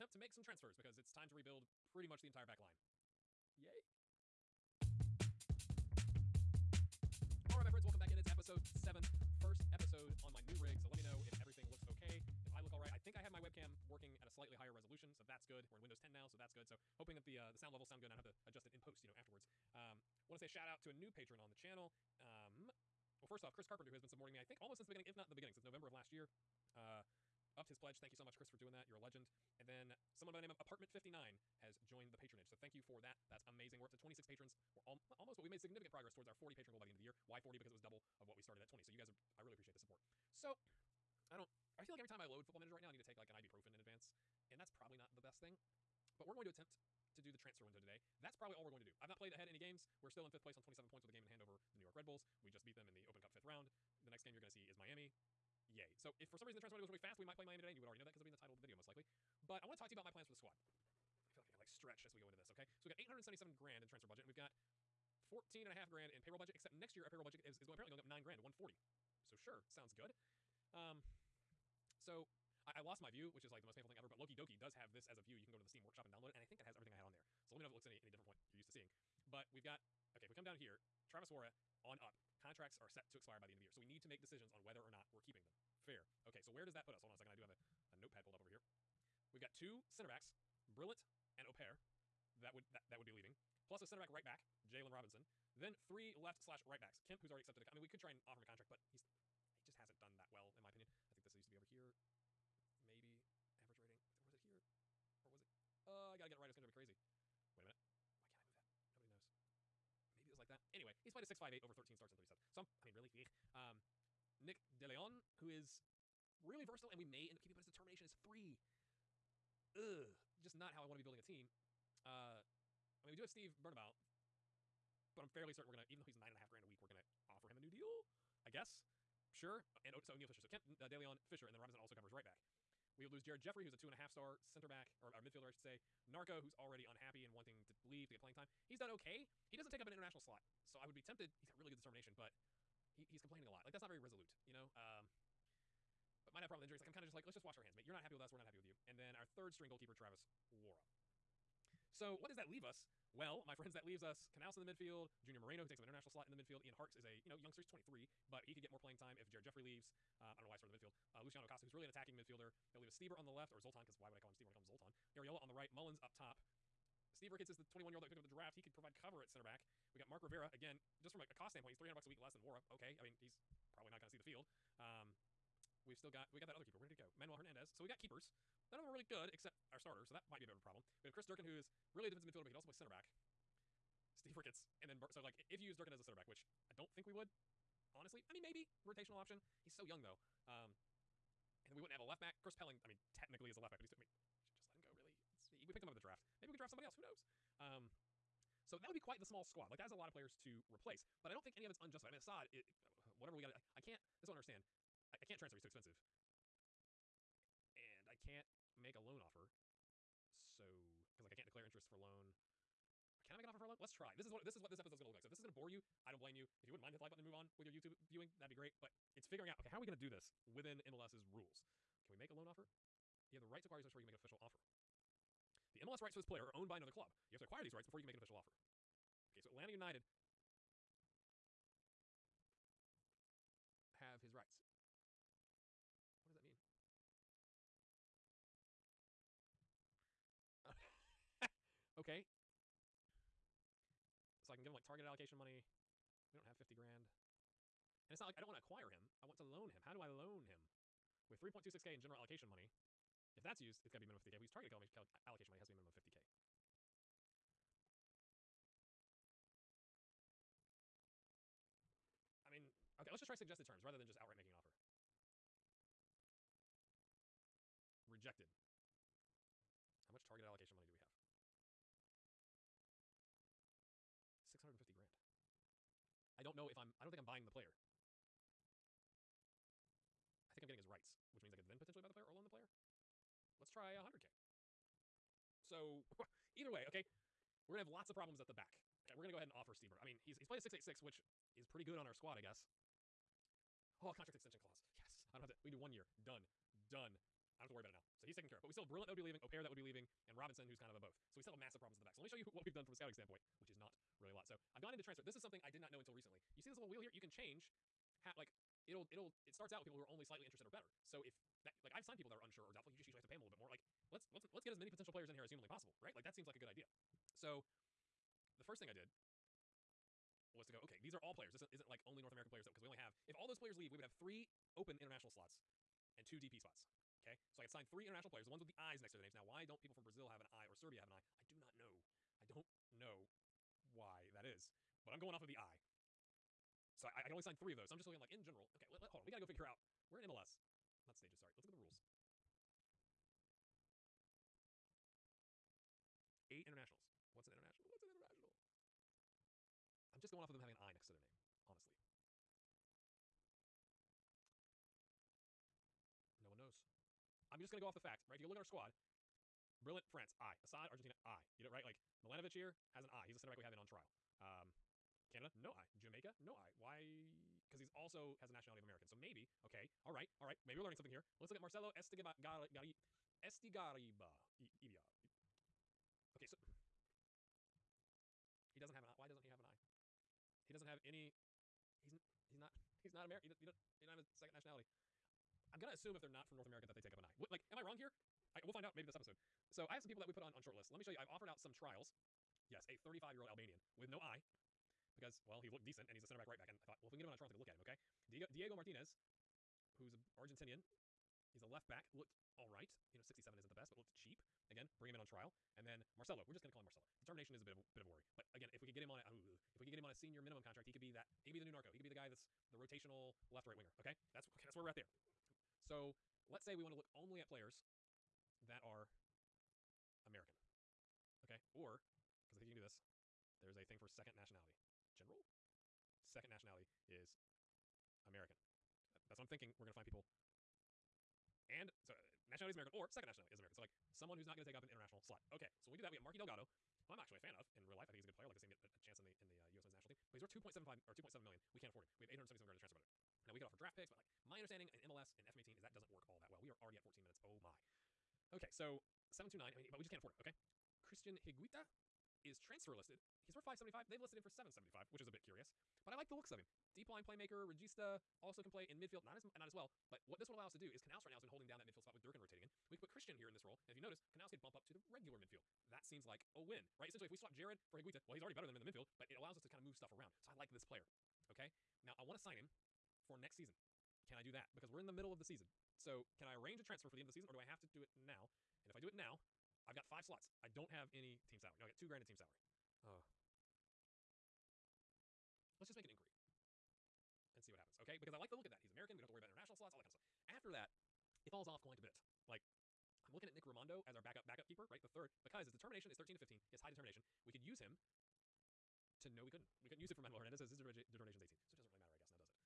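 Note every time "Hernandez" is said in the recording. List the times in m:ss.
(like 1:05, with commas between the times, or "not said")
2:57, 8:20.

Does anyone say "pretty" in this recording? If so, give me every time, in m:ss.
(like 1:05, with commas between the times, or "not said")
0:01, 4:51.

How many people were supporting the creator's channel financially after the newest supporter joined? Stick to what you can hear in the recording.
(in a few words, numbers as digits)
26.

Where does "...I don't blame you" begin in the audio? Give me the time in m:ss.
3:36.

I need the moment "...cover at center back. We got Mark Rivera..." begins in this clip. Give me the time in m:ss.
2:48.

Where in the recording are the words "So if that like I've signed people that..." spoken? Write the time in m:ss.
5:11.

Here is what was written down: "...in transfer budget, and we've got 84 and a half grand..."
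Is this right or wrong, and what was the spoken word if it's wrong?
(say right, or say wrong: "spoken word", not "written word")
wrong: "14", not "84".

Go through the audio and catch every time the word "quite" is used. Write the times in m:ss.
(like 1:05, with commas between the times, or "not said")
3:18, 8:11.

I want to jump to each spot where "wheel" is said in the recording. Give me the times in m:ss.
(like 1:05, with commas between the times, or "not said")
5:06.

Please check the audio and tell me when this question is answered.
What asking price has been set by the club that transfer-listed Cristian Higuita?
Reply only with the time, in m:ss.
7:34.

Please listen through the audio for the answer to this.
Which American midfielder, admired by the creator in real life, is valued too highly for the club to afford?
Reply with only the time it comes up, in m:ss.
7:16.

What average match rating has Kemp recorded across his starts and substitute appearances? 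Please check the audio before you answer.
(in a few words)
6.58.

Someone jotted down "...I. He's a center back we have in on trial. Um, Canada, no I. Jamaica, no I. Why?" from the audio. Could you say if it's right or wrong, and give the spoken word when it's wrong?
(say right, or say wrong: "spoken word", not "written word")
right.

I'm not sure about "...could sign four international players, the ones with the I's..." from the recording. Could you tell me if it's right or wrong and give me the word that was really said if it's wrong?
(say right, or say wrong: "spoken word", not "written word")
wrong: "three", not "four".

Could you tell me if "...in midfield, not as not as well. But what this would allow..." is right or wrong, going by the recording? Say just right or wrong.
right.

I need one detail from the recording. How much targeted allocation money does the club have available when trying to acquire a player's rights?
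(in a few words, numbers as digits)
650 grand.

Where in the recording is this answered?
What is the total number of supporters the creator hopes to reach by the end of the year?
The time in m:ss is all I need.
0:36.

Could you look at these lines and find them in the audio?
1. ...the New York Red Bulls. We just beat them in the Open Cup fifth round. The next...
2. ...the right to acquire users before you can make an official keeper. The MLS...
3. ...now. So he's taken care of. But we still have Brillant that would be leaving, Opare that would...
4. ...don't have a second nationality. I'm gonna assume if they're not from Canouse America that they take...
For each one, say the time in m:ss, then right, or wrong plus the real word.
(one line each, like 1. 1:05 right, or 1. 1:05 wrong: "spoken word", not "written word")
1. 0:51 right
2. 3:43 wrong: "offer", not "keeper"
3. 4:57 right
4. 6:24 wrong: "North", not "Canouse".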